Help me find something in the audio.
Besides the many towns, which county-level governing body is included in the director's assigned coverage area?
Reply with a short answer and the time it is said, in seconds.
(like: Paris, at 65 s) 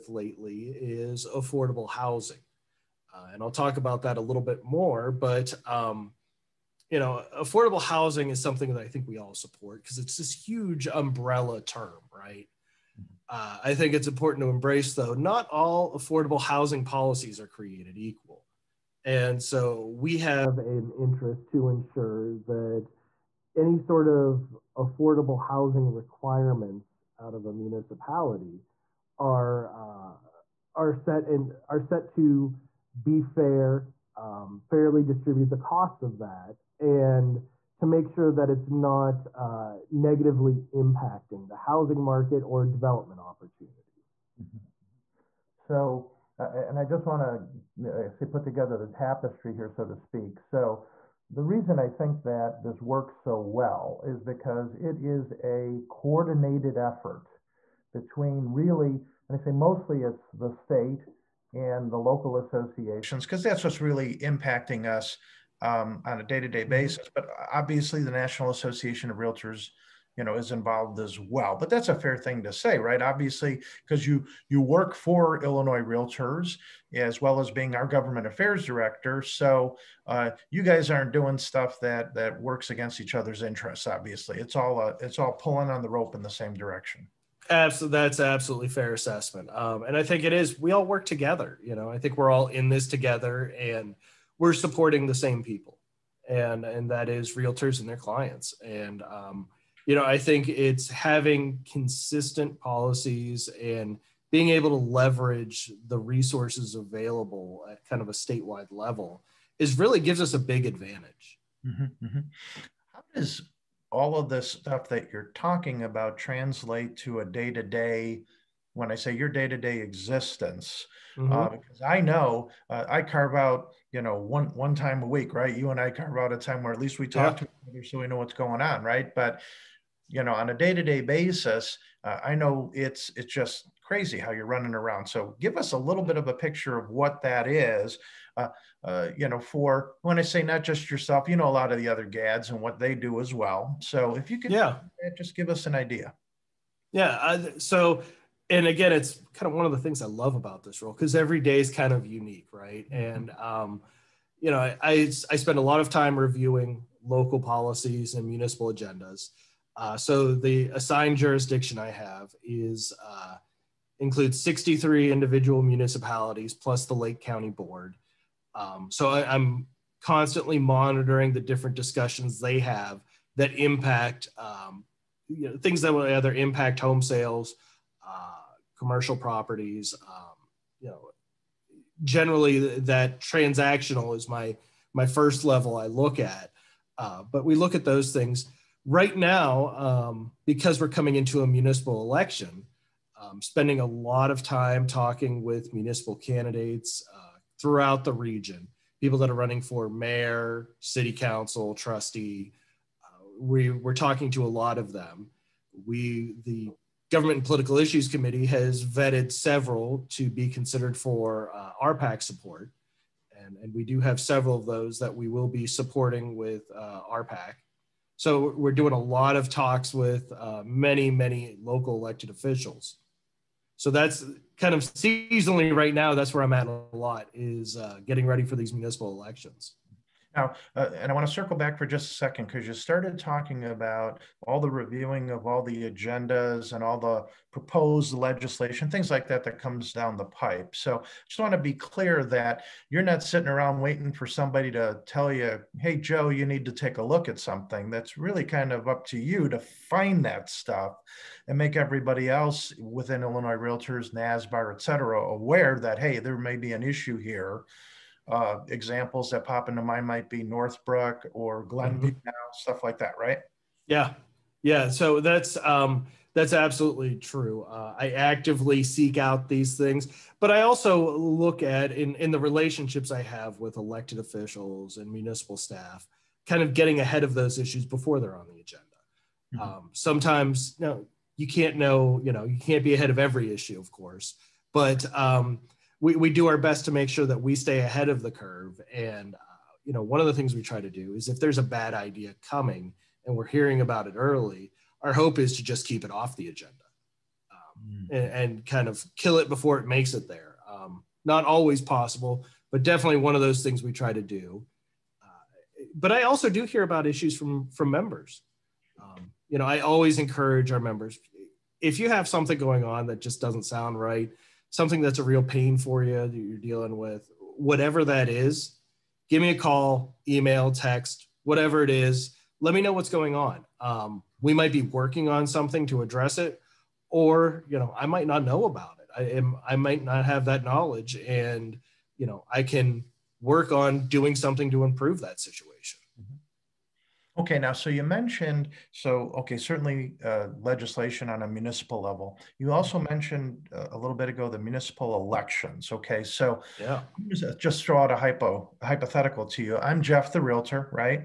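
Lake County Board, at 166 s.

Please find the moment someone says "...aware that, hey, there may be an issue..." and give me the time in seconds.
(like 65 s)
255 s.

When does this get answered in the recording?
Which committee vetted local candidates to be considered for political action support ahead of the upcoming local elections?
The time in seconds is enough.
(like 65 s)
207 s.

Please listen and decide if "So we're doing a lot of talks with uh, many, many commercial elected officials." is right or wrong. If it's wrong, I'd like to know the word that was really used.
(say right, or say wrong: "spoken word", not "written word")
wrong: "local", not "commercial".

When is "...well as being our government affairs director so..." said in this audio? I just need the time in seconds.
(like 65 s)
77 s.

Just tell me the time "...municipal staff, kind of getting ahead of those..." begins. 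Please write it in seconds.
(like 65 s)
275 s.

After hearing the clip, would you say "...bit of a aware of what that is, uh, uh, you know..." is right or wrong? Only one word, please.
wrong.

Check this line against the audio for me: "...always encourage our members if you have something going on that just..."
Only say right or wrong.
right.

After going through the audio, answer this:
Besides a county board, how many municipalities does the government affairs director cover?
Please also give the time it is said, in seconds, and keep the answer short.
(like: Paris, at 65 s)
63, at 164 s.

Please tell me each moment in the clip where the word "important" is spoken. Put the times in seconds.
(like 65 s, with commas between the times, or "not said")
14 s.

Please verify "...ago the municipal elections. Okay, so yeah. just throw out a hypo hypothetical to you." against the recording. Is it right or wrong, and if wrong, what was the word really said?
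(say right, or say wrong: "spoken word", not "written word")
right.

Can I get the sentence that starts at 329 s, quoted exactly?
I am I might not have that knowledge, and you know, I can work on doing something to improve that situation.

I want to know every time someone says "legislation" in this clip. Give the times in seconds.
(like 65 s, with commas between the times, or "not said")
238 s, 340 s.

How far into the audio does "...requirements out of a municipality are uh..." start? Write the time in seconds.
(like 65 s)
25 s.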